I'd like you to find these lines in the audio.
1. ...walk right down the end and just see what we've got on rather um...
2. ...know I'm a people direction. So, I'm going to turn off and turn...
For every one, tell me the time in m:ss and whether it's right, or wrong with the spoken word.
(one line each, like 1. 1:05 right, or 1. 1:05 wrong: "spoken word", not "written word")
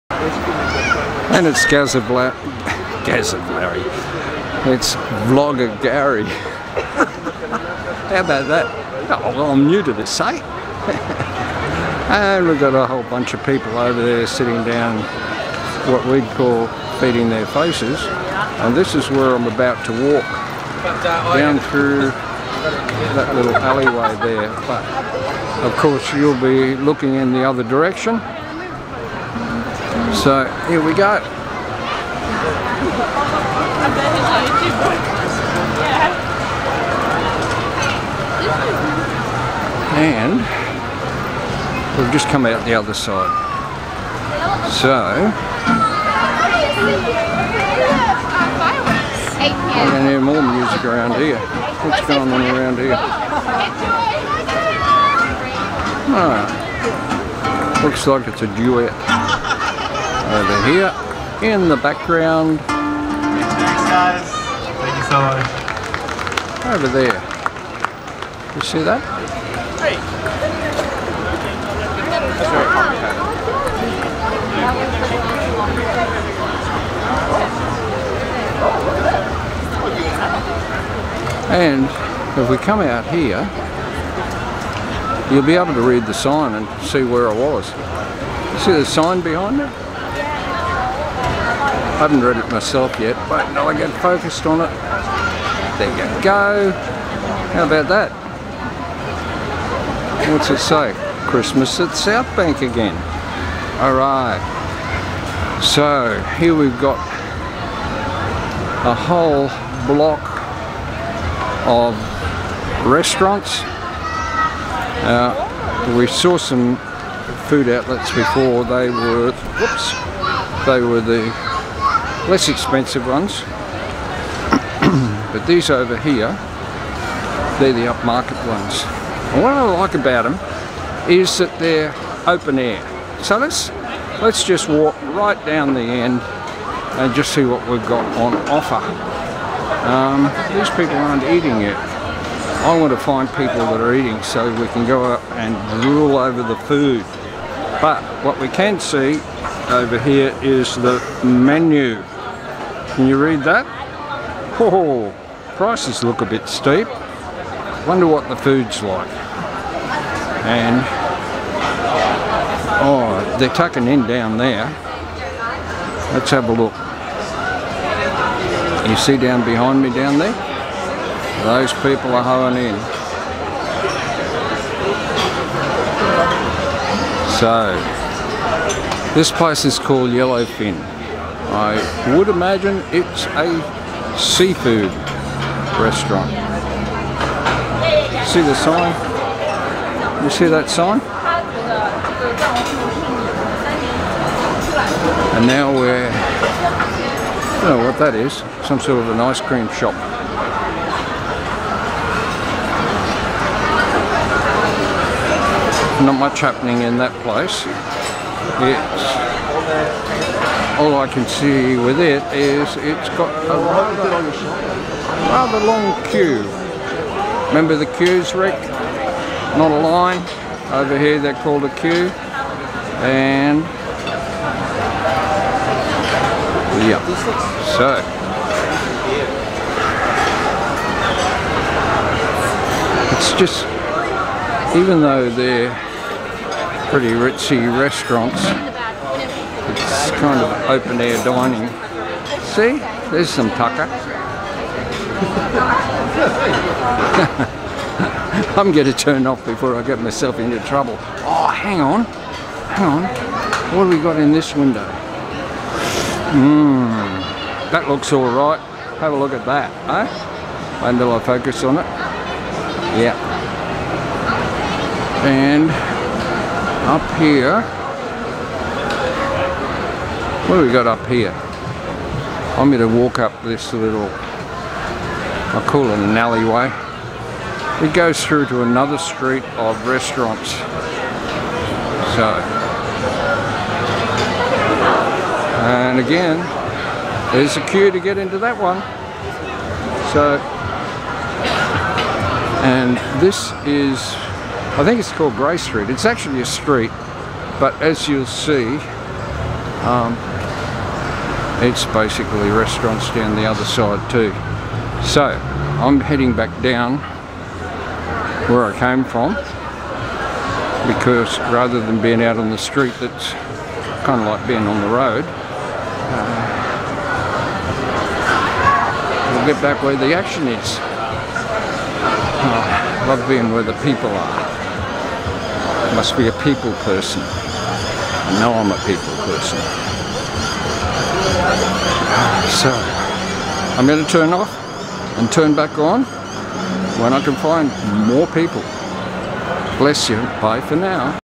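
1. 2:14 wrong: "offer", not "rather"
2. 5:28 wrong: "person", not "direction".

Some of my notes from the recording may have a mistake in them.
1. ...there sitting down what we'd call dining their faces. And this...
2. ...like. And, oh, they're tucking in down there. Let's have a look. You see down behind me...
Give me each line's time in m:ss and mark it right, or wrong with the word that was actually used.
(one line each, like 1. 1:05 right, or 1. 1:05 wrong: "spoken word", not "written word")
1. 0:14 wrong: "feeding", not "dining"
2. 2:38 right.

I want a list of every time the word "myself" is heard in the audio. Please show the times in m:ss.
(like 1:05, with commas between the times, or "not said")
1:32, 4:10.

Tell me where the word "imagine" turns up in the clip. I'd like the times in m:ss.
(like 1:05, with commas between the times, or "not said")
3:02.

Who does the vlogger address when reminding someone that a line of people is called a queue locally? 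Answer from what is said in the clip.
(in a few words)
Rick.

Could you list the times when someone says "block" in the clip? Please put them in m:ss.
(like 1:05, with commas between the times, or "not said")
1:49.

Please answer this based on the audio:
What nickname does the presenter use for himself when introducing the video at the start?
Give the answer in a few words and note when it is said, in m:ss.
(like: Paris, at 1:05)
Vlogger Garry, at 0:05.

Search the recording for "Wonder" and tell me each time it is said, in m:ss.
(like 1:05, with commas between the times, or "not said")
2:37.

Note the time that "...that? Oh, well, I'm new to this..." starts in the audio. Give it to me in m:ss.
0:08.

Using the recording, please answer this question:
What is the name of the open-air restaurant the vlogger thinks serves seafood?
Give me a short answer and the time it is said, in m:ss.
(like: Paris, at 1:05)
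Yellowfin, at 3:00.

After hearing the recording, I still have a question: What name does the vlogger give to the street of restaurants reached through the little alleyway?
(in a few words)
Grey Street.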